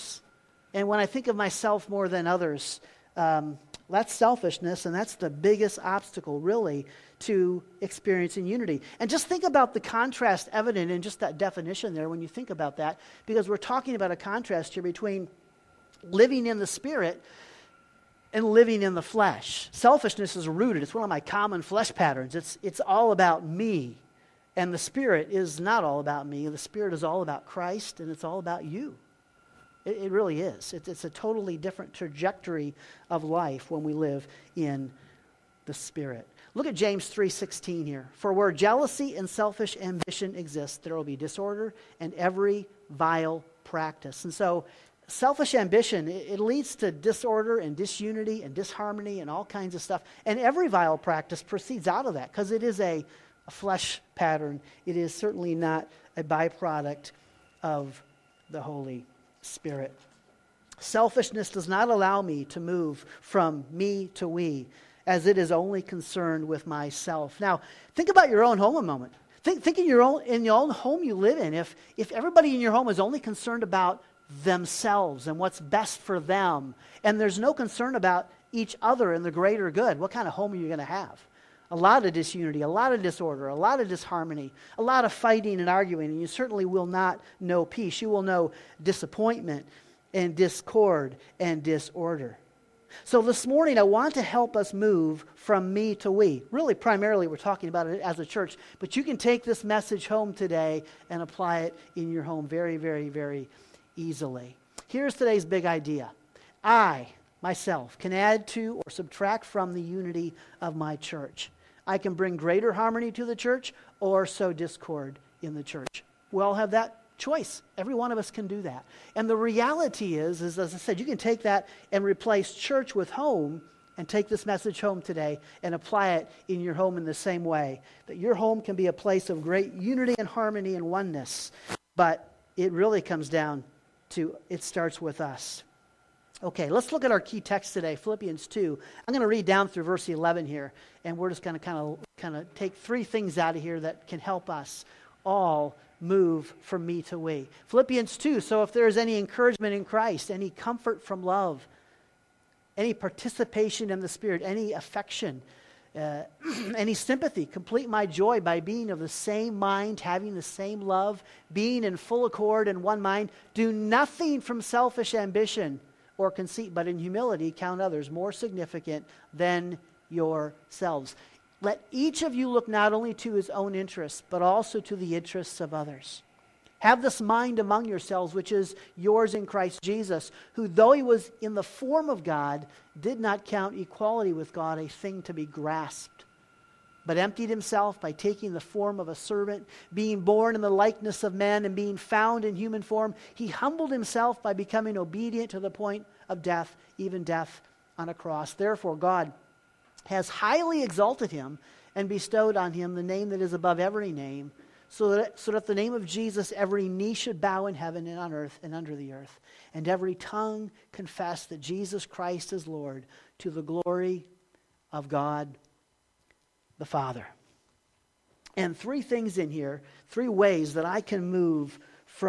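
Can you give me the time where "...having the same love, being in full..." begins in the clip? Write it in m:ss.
2:40.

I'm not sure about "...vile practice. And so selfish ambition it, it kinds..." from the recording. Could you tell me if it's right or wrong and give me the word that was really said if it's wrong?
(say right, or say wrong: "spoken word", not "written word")
wrong: "leads", not "kinds".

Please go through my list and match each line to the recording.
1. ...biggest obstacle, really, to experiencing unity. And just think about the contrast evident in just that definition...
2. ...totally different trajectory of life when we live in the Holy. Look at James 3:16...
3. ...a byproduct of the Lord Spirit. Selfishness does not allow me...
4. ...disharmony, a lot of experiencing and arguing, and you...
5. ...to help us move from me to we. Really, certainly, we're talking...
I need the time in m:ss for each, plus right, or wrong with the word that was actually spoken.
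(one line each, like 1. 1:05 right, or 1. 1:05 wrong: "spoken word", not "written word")
1. 0:05 right
2. 0:31 wrong: "Spirit", not "Holy"
3. 0:56 wrong: "Holy", not "Lord"
4. 1:23 wrong: "fighting", not "experiencing"
5. 1:34 wrong: "primarily", not "certainly".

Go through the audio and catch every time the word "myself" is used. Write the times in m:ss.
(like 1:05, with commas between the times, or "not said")
0:01, 1:06, 1:47.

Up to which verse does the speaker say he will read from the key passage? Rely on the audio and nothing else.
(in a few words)
11.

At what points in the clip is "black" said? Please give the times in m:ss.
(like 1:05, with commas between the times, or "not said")
not said.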